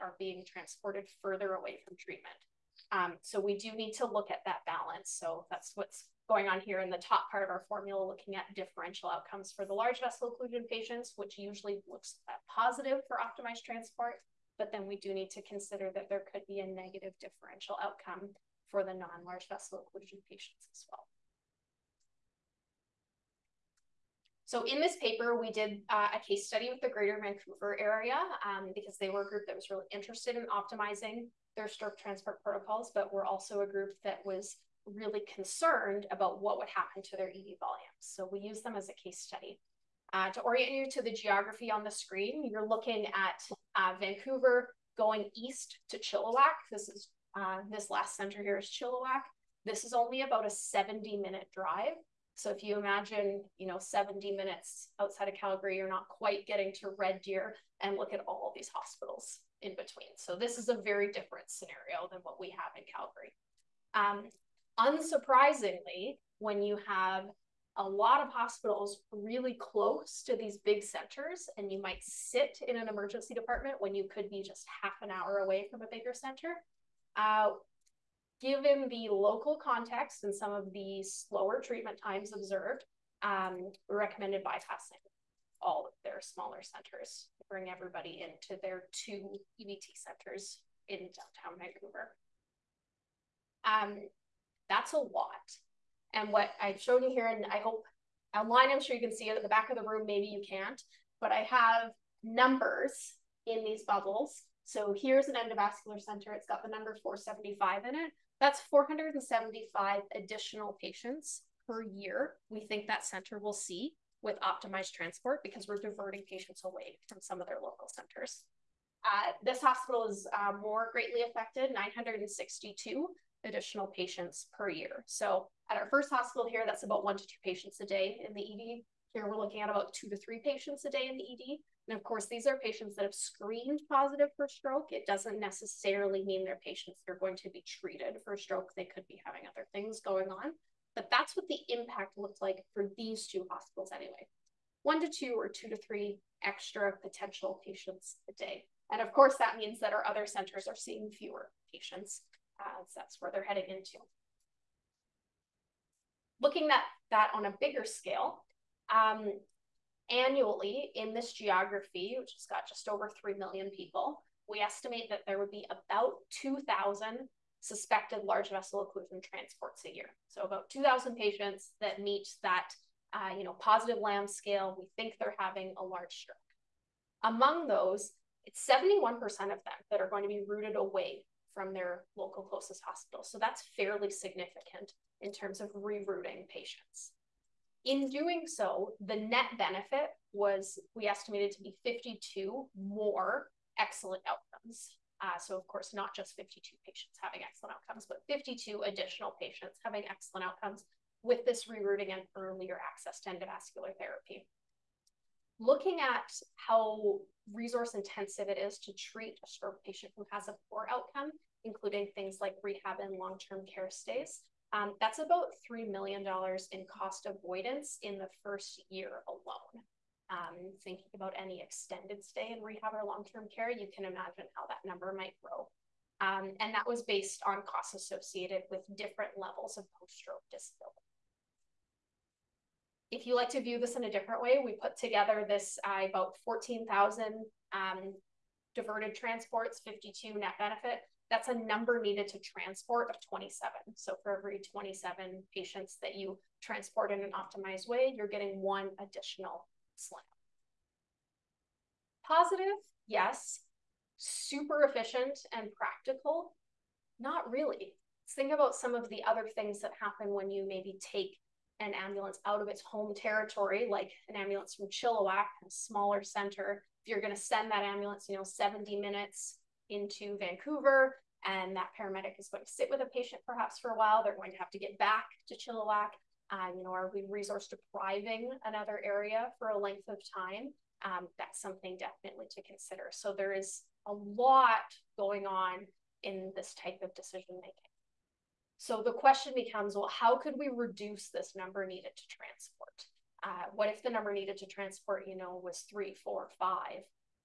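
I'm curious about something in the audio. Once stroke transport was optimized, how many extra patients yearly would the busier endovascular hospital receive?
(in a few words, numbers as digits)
962.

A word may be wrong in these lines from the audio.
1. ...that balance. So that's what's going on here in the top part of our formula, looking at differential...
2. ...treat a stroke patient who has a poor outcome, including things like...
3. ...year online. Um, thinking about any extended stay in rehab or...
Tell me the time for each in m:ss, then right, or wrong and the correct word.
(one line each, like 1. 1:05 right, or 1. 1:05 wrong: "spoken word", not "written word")
1. 0:04 right
2. 3:28 right
3. 3:38 wrong: "alone", not "online".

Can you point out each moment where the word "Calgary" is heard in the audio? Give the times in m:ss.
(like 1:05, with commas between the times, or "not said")
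0:55, 1:02.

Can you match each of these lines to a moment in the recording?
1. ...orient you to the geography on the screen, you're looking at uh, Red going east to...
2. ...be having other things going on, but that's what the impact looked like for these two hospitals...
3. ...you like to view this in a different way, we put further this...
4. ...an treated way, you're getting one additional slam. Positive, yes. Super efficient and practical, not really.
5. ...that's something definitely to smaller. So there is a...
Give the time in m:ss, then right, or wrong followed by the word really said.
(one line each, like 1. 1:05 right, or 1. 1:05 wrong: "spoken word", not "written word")
1. 0:40 wrong: "Vancouver", not "Red"
2. 2:19 right
3. 3:53 wrong: "together", not "further"
4. 4:07 wrong: "optimized", not "treated"
5. 4:41 wrong: "consider", not "smaller".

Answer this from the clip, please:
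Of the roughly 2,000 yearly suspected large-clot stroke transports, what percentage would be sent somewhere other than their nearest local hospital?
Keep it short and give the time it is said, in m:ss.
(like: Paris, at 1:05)
71%, at 2:58.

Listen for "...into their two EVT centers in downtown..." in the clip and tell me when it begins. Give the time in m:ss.
1:28.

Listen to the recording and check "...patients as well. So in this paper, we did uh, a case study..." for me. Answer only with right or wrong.
right.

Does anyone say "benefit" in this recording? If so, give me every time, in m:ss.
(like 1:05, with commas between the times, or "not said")
3:09, 4:00.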